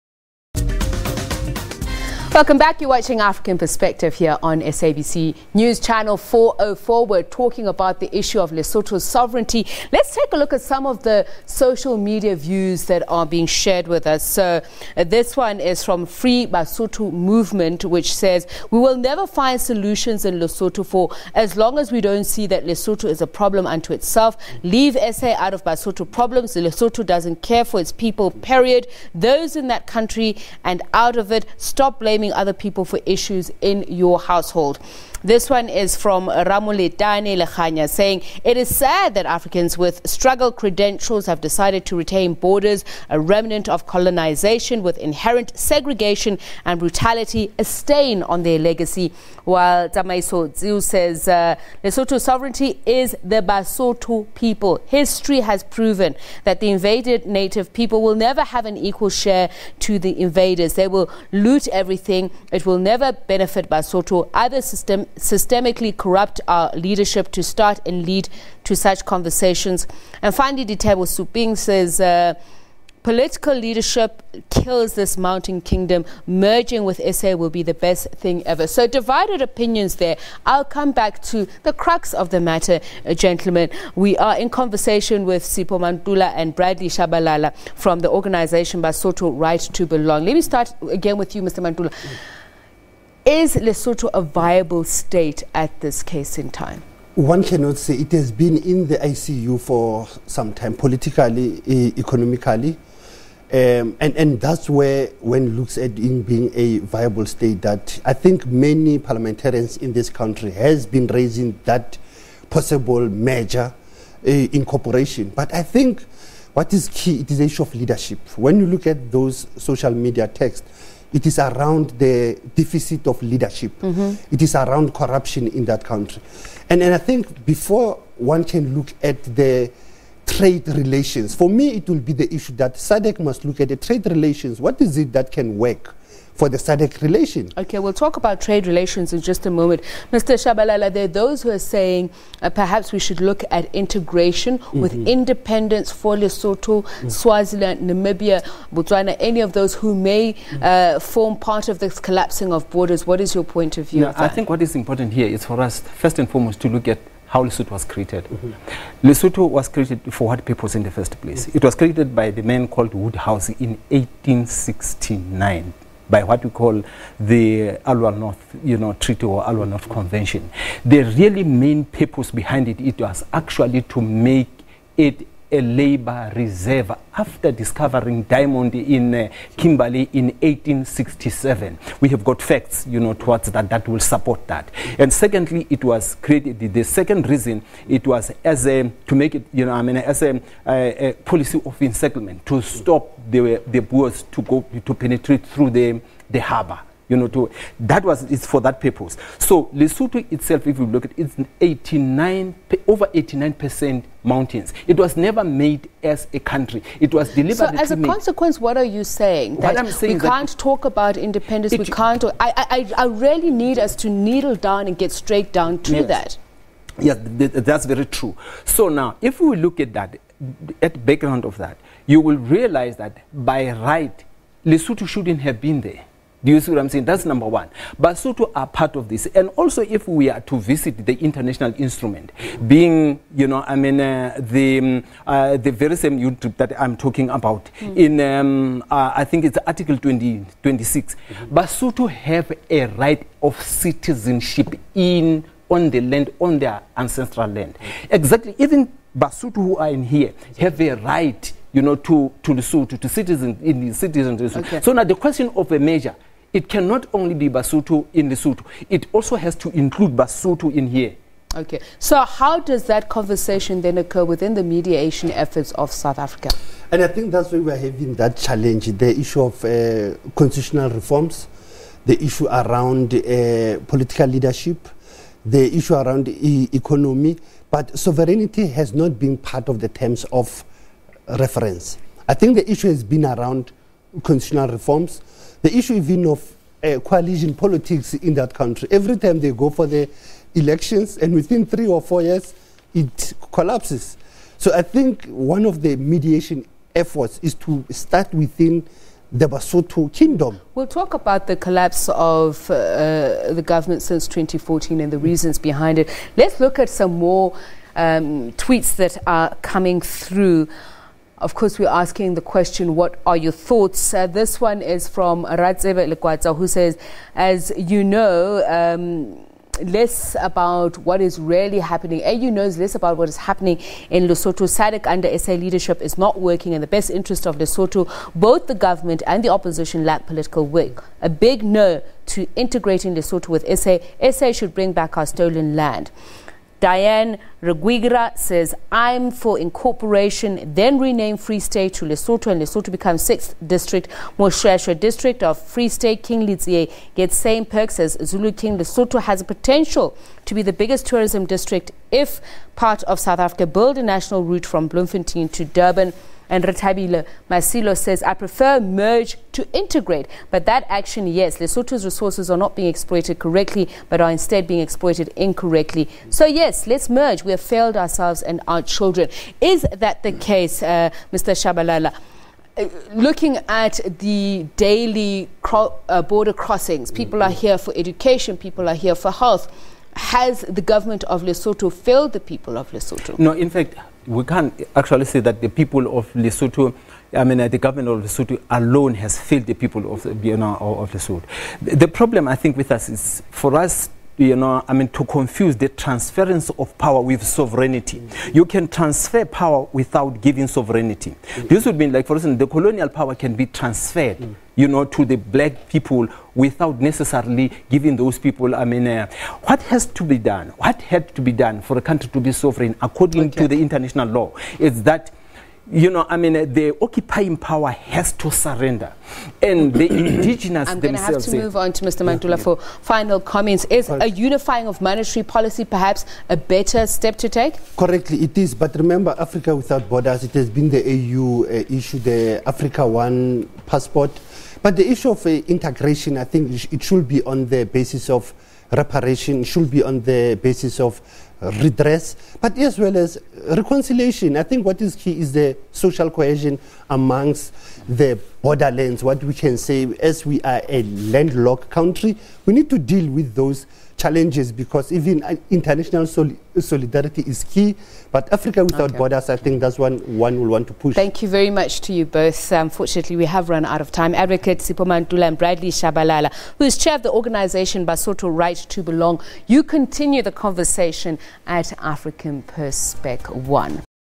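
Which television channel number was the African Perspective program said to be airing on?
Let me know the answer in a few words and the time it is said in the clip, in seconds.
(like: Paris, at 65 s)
404, at 6 s.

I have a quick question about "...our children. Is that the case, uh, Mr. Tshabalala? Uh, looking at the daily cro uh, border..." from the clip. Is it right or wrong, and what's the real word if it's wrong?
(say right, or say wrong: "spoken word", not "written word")
right.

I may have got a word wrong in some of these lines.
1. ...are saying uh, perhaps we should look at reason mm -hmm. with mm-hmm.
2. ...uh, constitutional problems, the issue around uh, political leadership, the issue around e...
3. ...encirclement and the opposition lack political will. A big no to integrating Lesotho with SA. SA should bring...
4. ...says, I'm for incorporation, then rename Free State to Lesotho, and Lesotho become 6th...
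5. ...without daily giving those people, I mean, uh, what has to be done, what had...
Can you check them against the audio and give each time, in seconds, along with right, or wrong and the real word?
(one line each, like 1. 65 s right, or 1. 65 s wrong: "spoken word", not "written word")
1. 141 s wrong: "integration", not "reason"
2. 269 s wrong: "reforms", not "problems"
3. 328 s wrong: "government", not "encirclement"
4. 338 s right
5. 406 s wrong: "necessarily", not "daily".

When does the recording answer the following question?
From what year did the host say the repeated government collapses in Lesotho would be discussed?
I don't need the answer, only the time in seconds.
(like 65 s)
304 s.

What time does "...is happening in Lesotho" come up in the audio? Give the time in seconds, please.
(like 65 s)
323 s.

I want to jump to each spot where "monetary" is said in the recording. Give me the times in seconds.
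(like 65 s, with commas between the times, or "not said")
425 s.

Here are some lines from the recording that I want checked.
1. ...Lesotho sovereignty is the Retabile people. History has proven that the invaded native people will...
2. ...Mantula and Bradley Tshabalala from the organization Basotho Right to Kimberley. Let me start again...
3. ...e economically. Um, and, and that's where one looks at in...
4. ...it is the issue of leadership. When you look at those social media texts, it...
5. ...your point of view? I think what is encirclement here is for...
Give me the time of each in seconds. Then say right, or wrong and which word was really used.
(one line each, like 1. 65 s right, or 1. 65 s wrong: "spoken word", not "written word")
1. 51 s wrong: "Basotho", not "Retabile"
2. 85 s wrong: "Belong", not "Kimberley"
3. 101 s right
4. 117 s right
5. 153 s wrong: "important", not "encirclement".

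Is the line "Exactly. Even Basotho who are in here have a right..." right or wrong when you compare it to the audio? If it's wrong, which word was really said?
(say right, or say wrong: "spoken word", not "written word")
right.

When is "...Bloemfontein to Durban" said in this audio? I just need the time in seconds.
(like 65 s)
354 s.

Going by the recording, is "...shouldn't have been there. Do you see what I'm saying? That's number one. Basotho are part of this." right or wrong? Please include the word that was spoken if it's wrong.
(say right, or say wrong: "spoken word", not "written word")
right.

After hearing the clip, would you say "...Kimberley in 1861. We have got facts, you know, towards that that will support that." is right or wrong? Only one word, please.
wrong.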